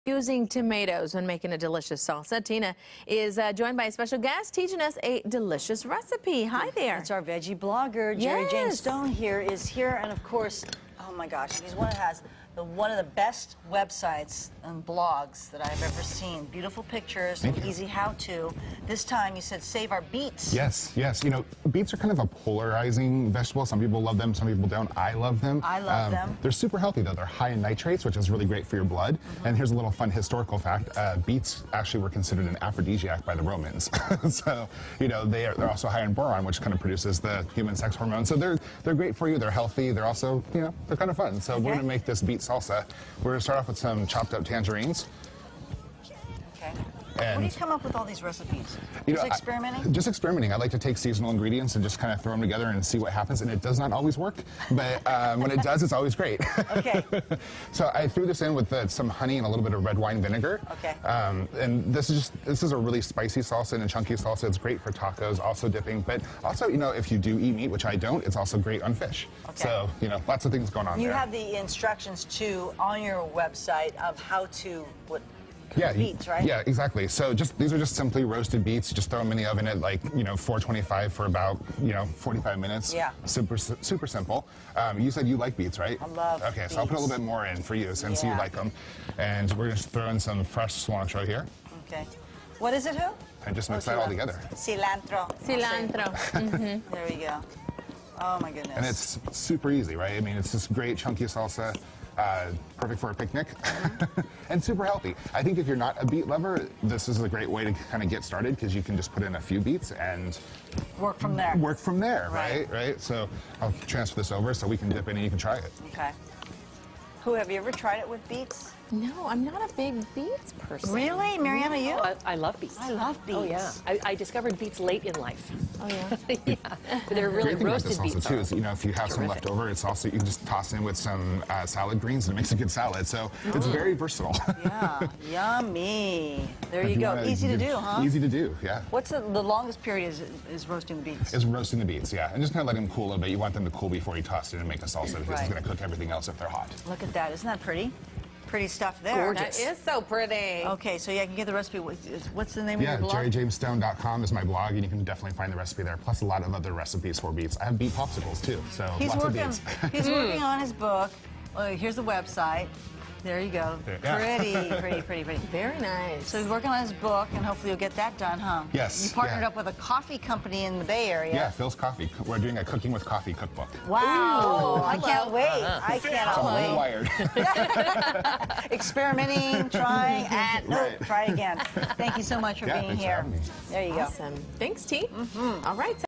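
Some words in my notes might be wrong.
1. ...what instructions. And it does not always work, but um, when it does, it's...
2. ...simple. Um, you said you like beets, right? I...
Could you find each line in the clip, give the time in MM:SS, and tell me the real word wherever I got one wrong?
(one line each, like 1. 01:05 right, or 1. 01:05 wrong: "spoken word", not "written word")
1. 00:52 wrong: "happens", not "instructions"
2. 01:24 right.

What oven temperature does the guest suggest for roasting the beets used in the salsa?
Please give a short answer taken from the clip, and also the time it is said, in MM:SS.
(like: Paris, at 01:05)
425, at 01:20.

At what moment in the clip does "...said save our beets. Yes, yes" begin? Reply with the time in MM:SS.
00:19.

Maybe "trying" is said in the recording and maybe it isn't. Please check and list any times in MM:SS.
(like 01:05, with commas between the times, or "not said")
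02:59.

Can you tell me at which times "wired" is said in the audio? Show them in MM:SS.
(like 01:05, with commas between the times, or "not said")
02:57.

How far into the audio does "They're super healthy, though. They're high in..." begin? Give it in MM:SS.
00:26.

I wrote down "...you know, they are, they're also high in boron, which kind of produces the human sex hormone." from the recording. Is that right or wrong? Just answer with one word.
right.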